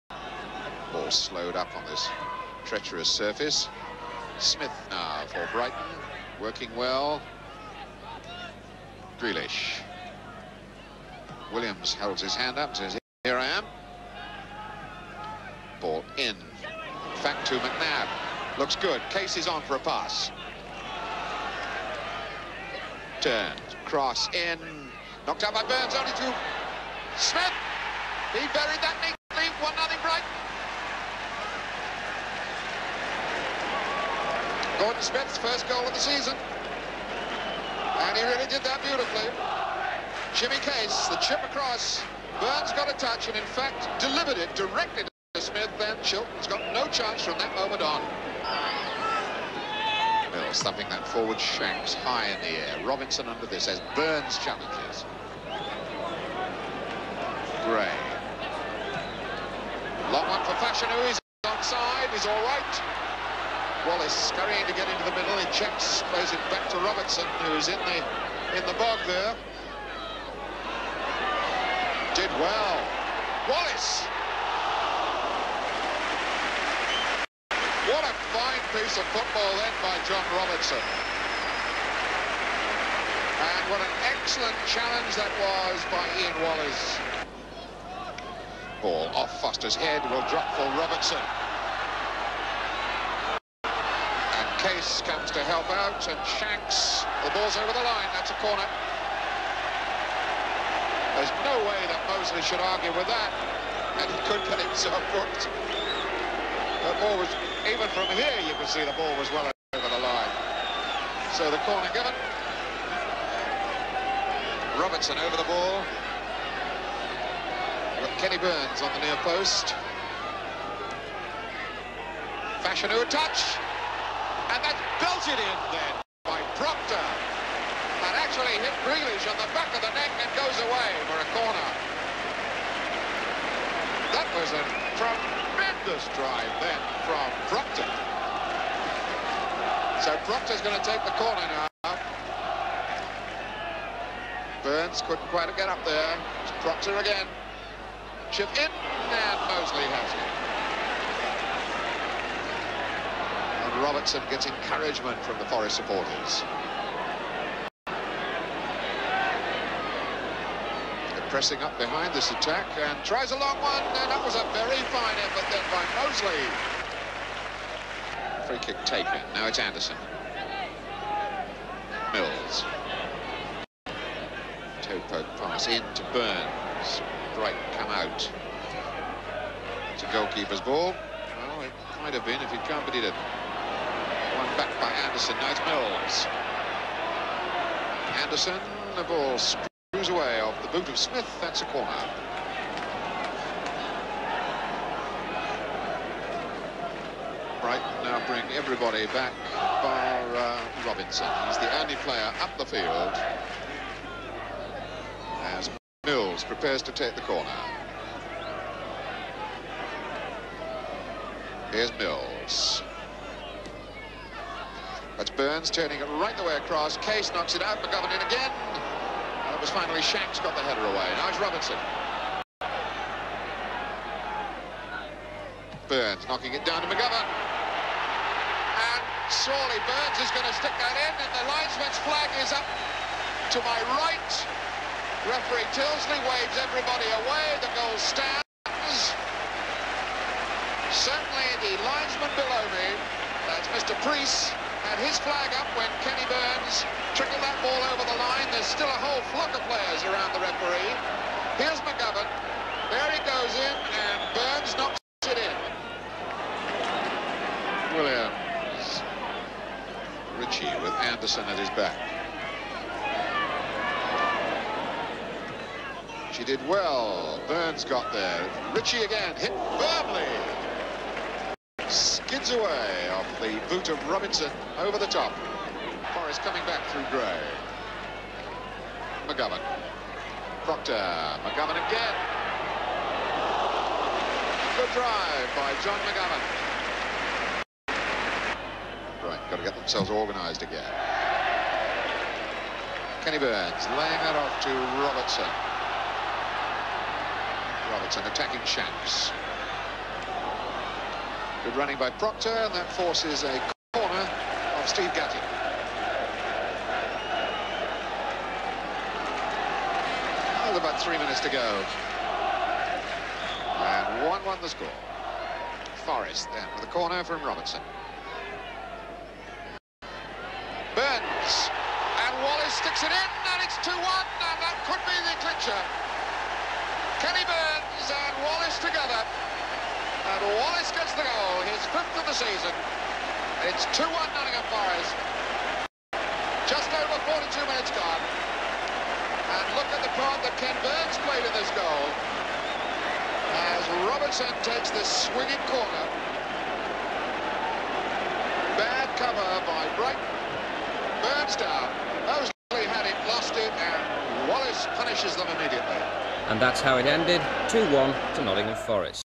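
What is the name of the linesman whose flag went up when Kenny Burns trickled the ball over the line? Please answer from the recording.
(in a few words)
Mr. Priest.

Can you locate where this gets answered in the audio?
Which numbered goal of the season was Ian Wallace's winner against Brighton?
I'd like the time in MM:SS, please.
05:31.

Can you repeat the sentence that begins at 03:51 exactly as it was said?
And the linesman's flag is up to my right.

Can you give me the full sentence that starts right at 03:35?
That's Burns turning it right the way across.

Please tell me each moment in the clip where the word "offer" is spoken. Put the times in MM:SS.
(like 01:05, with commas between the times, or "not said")
not said.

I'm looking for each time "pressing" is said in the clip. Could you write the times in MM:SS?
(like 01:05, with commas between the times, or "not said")
02:41.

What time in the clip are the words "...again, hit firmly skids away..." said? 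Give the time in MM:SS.
04:29.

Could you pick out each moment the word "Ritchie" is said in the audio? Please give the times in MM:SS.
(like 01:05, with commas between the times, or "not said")
04:20, 04:28.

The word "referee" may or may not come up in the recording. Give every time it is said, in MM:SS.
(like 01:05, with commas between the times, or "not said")
03:55, 04:10.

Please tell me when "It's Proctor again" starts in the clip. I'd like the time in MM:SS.
02:26.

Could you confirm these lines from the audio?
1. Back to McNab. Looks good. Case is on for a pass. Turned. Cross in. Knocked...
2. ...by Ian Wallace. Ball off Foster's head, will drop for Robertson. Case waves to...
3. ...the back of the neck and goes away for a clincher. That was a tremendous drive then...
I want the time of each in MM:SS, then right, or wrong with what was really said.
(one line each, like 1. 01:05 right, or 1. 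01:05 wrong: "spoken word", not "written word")
1. 00:17 right
2. 01:25 wrong: "comes", not "waves"
3. 02:09 wrong: "corner", not "clincher".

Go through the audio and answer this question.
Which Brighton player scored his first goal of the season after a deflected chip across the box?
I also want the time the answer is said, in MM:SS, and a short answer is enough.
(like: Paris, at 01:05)
Gordon Smith, at 00:34.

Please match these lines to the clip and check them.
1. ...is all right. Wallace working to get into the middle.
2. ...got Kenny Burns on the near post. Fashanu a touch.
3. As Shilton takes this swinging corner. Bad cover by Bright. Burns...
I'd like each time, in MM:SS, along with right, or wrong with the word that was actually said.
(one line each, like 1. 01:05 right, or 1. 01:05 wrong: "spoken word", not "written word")
1. 01:02 wrong: "scurrying", not "working"
2. 01:58 right
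3. 05:43 wrong: "Robertson", not "Shilton".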